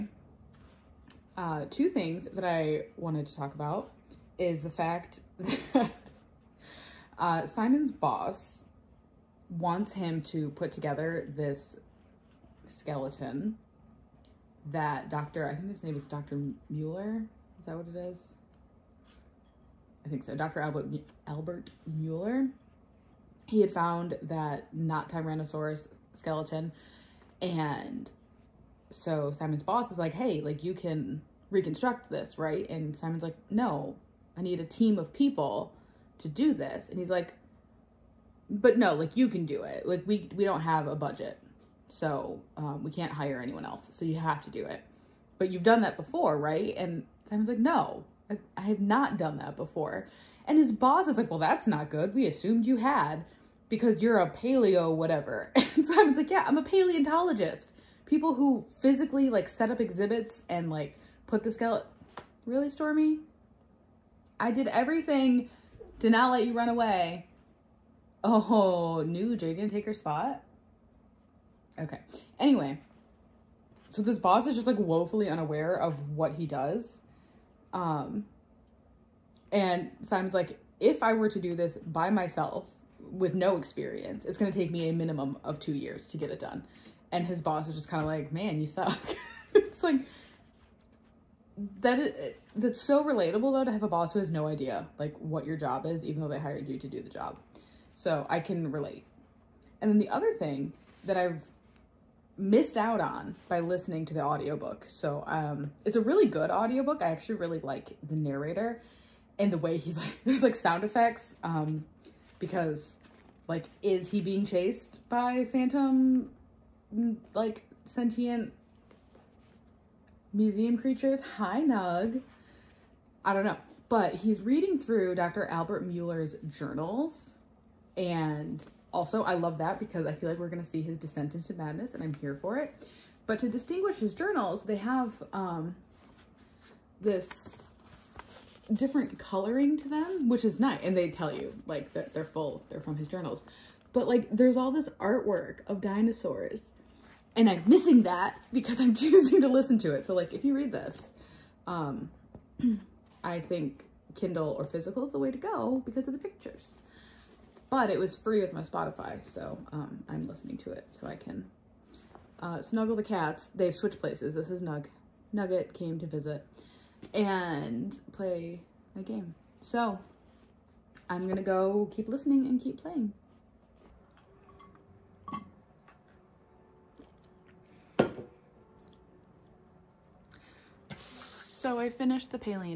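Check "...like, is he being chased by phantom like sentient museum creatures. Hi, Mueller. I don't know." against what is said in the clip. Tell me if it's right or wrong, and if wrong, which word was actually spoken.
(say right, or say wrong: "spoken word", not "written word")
wrong: "Nug", not "Mueller".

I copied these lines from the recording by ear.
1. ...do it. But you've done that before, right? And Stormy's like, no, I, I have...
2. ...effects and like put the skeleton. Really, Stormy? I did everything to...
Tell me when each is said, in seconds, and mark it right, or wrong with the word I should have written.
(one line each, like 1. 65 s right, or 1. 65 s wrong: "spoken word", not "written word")
1. 44 s wrong: "Simon", not "Stormy"
2. 59 s wrong: "exhibits", not "effects".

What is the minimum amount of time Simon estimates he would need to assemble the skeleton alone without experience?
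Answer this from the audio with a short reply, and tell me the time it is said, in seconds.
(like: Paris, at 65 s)
2 years, at 85 s.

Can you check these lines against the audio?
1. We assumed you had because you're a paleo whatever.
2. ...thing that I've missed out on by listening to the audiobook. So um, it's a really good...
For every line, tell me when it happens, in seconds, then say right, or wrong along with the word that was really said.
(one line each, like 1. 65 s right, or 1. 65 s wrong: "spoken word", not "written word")
1. 52 s right
2. 100 s right.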